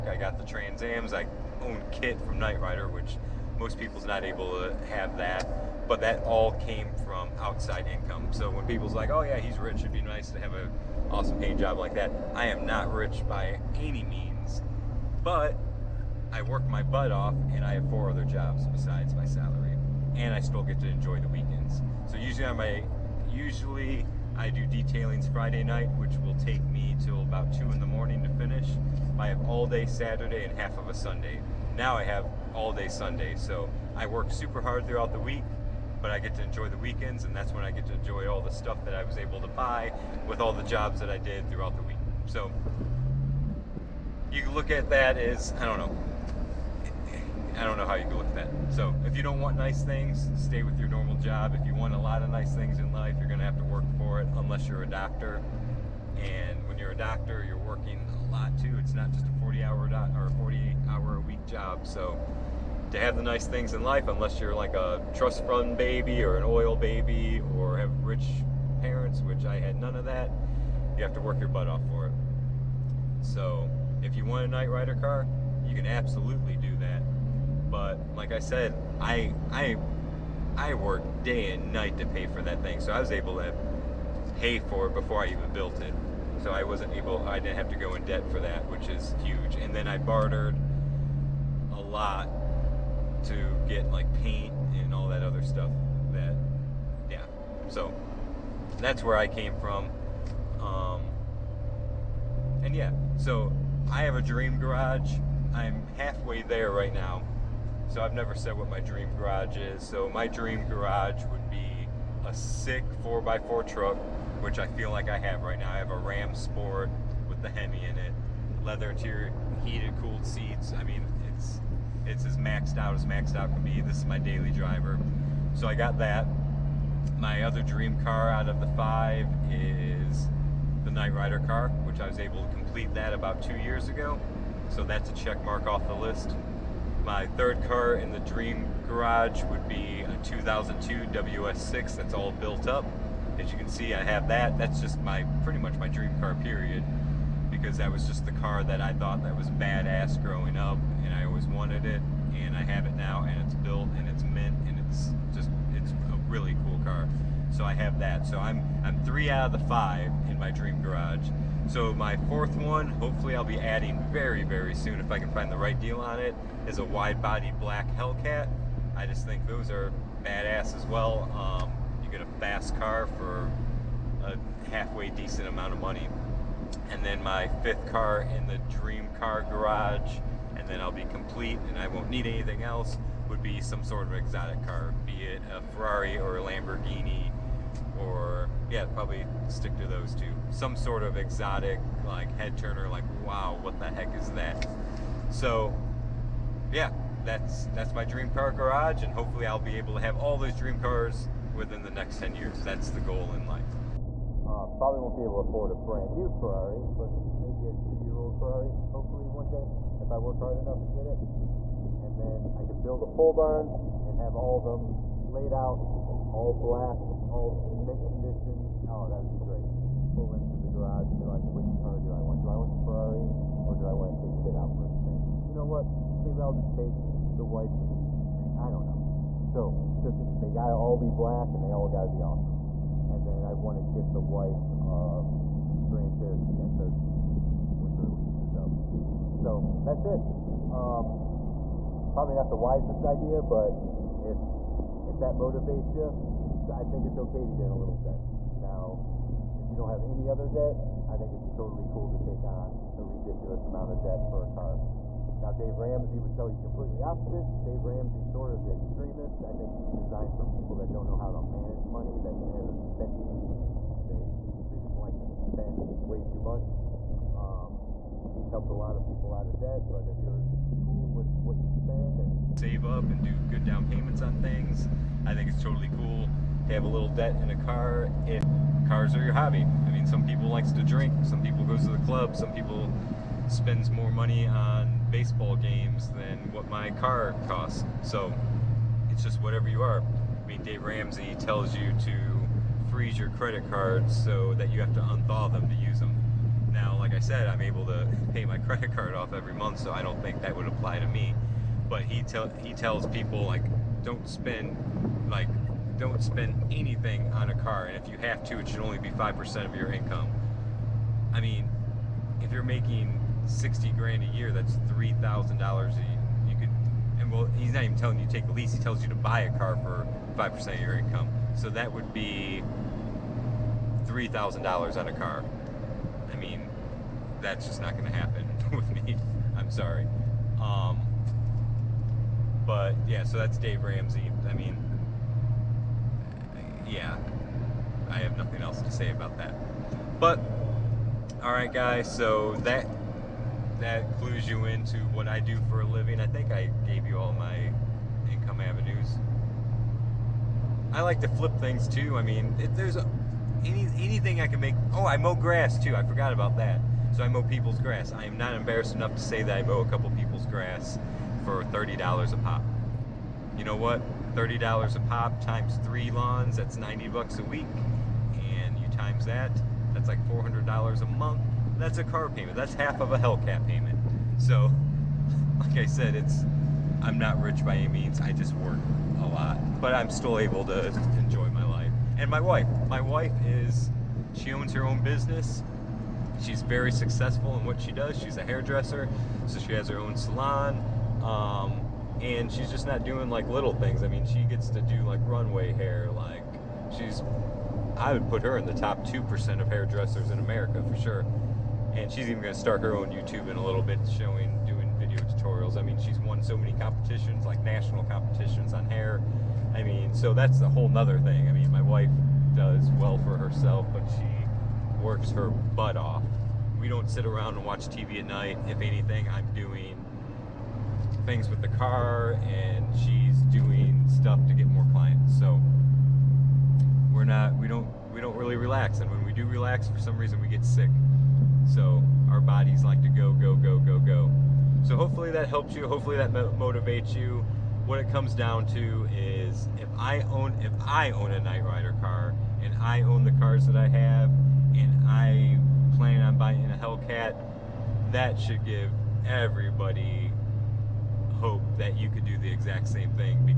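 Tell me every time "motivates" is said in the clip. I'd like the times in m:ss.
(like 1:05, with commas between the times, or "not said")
4:05, 7:16.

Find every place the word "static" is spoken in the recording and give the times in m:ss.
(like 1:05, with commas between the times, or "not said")
not said.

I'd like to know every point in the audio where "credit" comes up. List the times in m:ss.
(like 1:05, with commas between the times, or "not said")
4:53, 4:58.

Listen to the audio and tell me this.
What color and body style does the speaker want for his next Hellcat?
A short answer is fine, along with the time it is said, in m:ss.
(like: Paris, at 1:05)
Wide body black, at 2:46.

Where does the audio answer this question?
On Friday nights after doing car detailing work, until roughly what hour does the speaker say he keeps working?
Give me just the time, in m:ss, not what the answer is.
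0:27.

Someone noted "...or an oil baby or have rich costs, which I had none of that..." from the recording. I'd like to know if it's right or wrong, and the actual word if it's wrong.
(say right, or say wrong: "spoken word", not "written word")
wrong: "parents", not "costs".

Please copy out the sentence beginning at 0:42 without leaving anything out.
So you can look at that as, I don't know, I don't know how you can look with that.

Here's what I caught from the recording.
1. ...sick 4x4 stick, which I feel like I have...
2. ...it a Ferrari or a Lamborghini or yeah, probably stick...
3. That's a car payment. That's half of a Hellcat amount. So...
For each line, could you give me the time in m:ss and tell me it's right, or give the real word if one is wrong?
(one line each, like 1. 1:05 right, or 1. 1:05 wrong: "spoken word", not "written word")
1. 1:52 wrong: "truck", not "stick"
2. 3:05 right
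3. 6:11 wrong: "payment", not "amount".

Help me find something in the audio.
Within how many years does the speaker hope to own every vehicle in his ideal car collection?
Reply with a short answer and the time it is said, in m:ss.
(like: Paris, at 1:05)
10 years, at 3:22.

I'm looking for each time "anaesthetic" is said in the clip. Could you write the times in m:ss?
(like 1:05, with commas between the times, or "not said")
not said.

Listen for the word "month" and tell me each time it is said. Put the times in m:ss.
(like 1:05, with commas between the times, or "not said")
4:59, 6:11.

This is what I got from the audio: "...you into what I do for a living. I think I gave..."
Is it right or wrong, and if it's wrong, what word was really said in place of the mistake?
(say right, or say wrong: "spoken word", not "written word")
right.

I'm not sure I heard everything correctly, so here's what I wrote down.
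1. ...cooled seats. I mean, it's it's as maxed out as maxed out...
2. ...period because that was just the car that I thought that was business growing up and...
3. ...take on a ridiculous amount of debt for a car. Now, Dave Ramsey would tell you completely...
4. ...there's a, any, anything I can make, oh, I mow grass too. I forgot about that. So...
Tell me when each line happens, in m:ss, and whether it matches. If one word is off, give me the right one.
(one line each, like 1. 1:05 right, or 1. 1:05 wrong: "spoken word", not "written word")
1. 1:59 right
2. 2:26 wrong: "badass", not "business"
3. 4:12 right
4. 5:52 right.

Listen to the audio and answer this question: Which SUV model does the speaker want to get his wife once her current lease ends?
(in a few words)
Grand Cherokee SRT.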